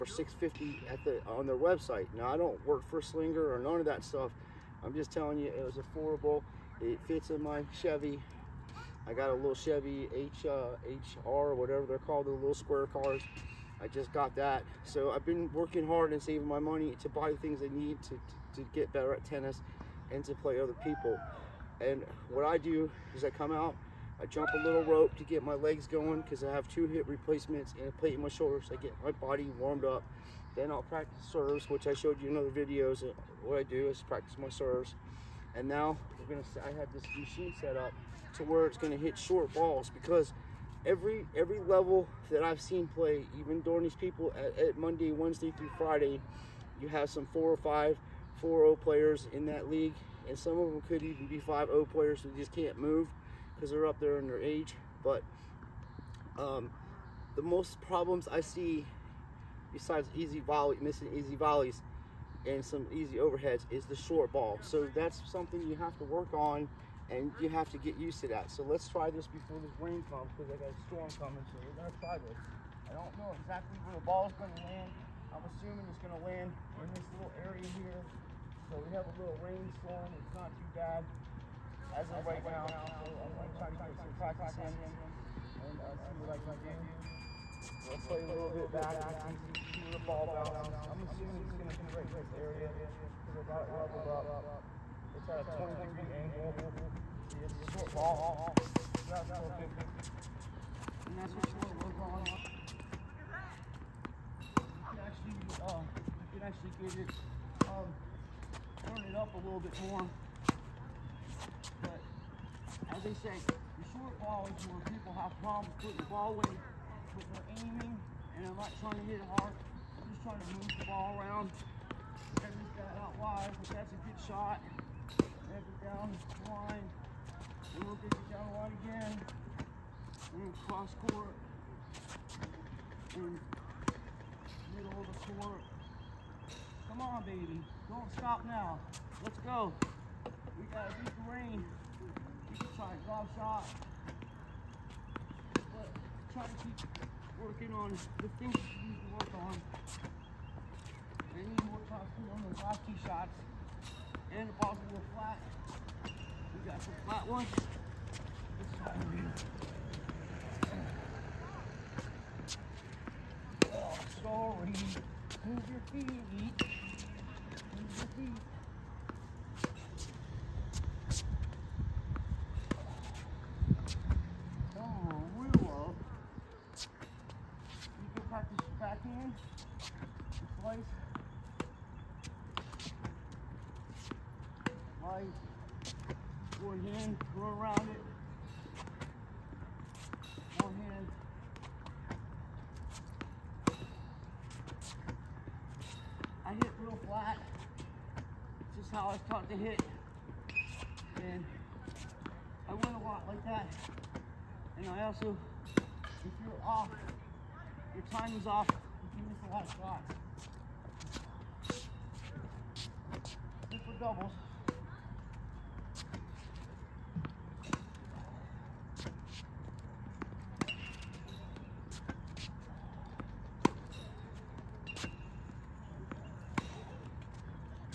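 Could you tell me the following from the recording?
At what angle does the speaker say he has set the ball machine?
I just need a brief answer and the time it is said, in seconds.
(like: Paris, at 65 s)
20 degrees, at 95 s.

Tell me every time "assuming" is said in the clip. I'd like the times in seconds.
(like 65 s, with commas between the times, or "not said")
75 s, 91 s.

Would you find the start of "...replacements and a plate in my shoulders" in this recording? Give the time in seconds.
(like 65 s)
27 s.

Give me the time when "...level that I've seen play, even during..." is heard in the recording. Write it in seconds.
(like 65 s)
41 s.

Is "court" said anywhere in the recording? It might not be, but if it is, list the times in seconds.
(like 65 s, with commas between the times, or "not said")
131 s, 135 s.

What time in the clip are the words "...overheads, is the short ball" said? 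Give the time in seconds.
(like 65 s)
63 s.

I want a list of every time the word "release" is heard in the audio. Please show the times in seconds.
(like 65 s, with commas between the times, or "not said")
not said.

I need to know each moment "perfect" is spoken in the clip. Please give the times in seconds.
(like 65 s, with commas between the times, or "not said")
99 s.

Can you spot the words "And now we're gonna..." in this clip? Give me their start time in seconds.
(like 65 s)
35 s.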